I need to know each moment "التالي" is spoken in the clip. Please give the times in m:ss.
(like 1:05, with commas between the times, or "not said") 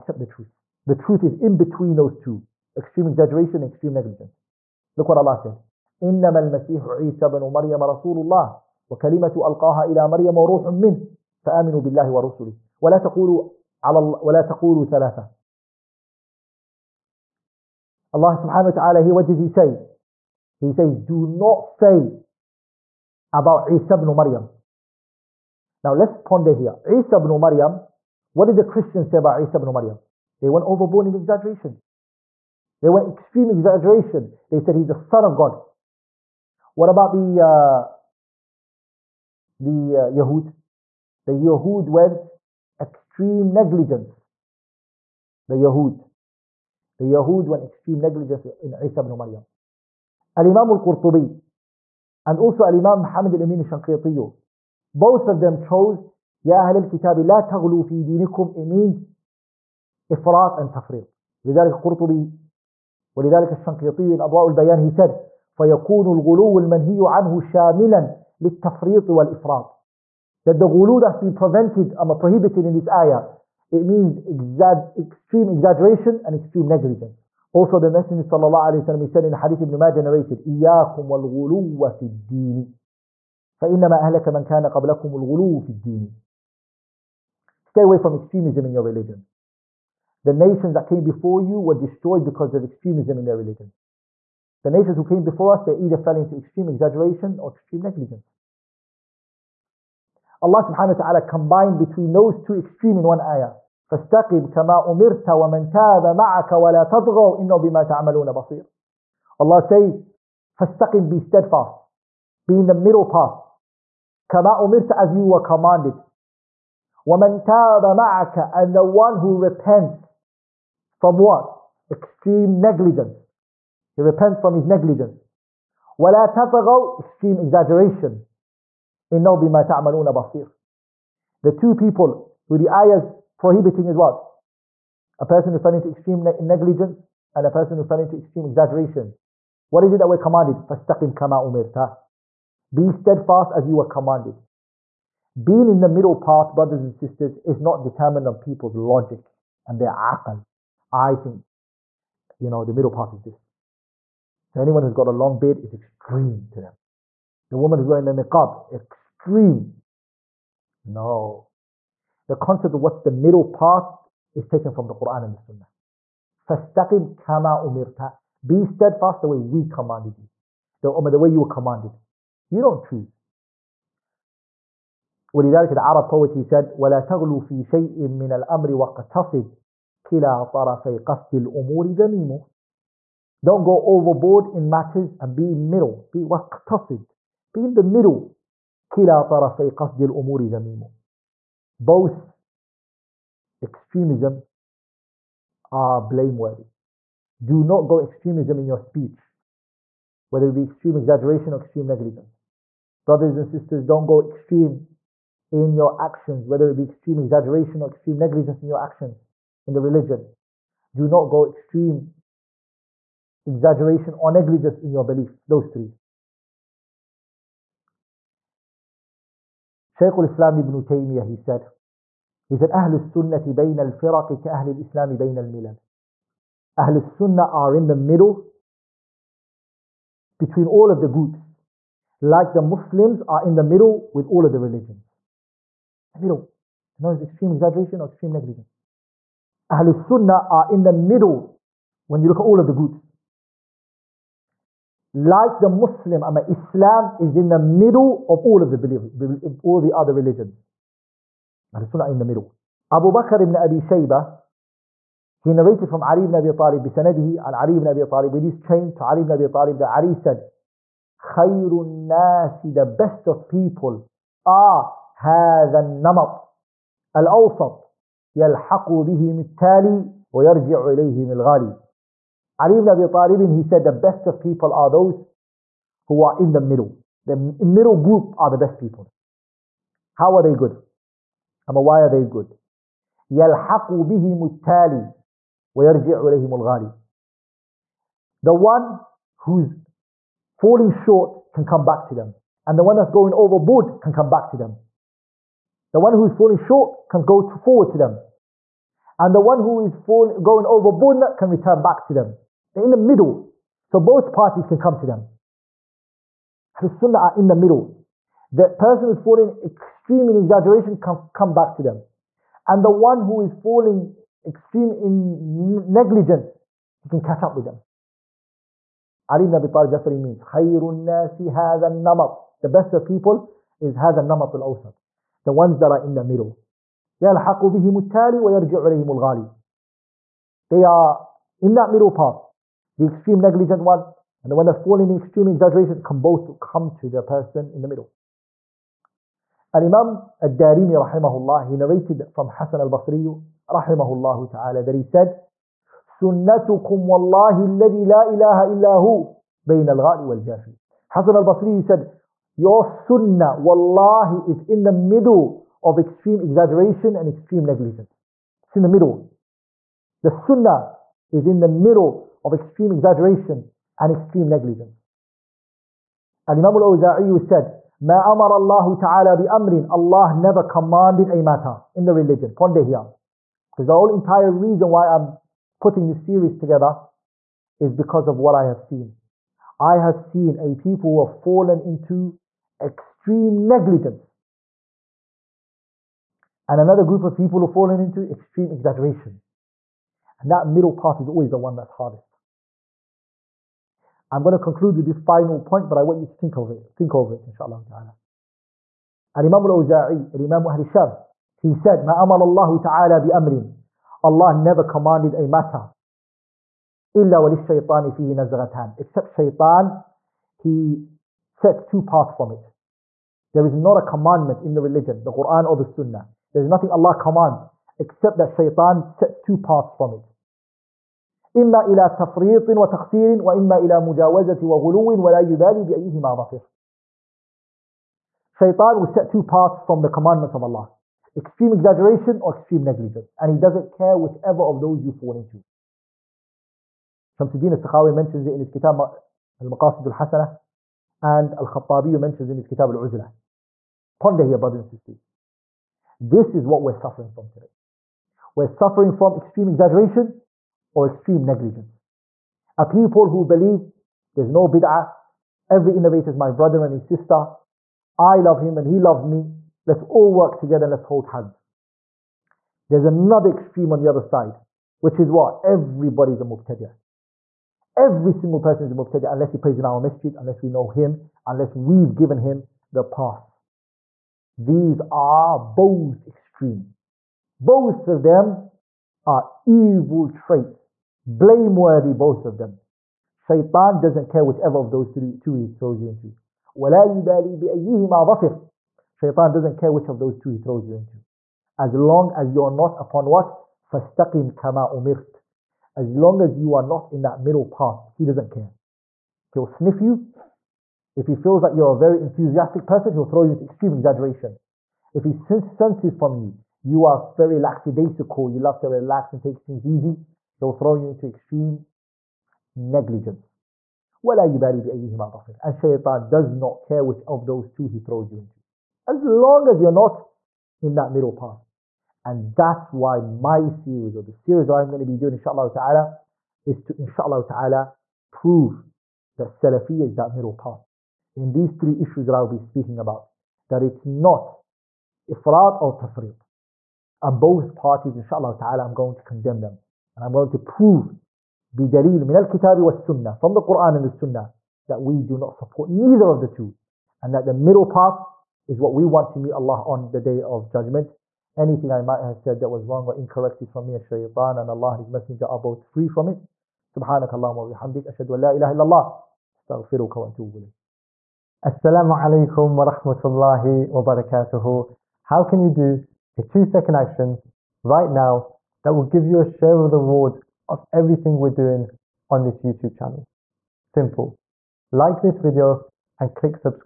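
4:29, 4:44, 5:28.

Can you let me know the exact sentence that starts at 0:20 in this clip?
He says do not say about Isa ibn Maryam.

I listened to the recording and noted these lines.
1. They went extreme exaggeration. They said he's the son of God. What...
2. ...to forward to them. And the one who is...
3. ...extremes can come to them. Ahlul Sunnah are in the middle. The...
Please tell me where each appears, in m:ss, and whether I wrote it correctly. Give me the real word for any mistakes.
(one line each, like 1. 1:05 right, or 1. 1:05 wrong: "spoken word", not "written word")
1. 0:32 right
2. 4:57 right
3. 5:04 wrong: "parties", not "extremes".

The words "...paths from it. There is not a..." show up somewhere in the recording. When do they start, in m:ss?
6:52.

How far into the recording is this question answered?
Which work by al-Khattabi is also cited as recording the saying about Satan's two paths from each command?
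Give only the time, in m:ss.
7:22.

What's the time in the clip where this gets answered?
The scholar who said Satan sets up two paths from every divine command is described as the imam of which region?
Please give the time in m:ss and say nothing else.
6:40.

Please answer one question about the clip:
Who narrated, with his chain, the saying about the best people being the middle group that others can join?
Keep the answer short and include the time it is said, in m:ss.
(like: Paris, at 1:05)
Abu Bakr ibn Abi Shayba, at 4:12.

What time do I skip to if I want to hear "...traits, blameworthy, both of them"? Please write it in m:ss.
8:00.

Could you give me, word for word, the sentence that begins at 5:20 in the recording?
خَيْرُ النَّاسِ هَذَا النَّمَطِ The best of people is هذا النمط الأوسط.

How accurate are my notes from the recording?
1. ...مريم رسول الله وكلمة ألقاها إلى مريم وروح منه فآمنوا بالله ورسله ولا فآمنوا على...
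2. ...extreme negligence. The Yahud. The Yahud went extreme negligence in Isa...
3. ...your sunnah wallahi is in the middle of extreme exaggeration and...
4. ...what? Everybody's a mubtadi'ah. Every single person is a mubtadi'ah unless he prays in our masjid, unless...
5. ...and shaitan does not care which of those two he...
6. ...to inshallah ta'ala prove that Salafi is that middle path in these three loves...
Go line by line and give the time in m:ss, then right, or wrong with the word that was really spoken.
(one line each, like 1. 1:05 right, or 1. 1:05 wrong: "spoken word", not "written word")
1. 0:07 wrong: "تقولوا", not "فآمنوا"
2. 0:42 right
3. 5:52 right
4. 7:45 right
5. 8:35 right
6. 8:46 wrong: "issues", not "loves".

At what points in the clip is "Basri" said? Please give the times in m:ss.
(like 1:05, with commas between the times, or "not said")
5:42, 5:51.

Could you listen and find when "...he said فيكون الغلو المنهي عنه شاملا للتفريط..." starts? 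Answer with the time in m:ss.
1:04.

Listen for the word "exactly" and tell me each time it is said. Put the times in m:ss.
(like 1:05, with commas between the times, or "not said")
not said.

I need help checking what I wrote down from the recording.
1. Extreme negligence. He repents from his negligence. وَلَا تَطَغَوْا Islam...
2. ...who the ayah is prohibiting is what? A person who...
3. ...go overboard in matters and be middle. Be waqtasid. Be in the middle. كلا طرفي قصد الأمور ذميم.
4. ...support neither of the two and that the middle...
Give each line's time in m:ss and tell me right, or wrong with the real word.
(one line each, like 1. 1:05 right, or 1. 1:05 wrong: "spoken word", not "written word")
1. 2:01 wrong: "Extreme", not "Islam"
2. 2:12 right
3. 3:03 right
4. 9:05 right.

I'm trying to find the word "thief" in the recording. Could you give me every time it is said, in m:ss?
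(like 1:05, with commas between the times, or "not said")
not said.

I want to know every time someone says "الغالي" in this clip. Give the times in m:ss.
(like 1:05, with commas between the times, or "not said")
4:31, 4:46, 5:29, 5:49.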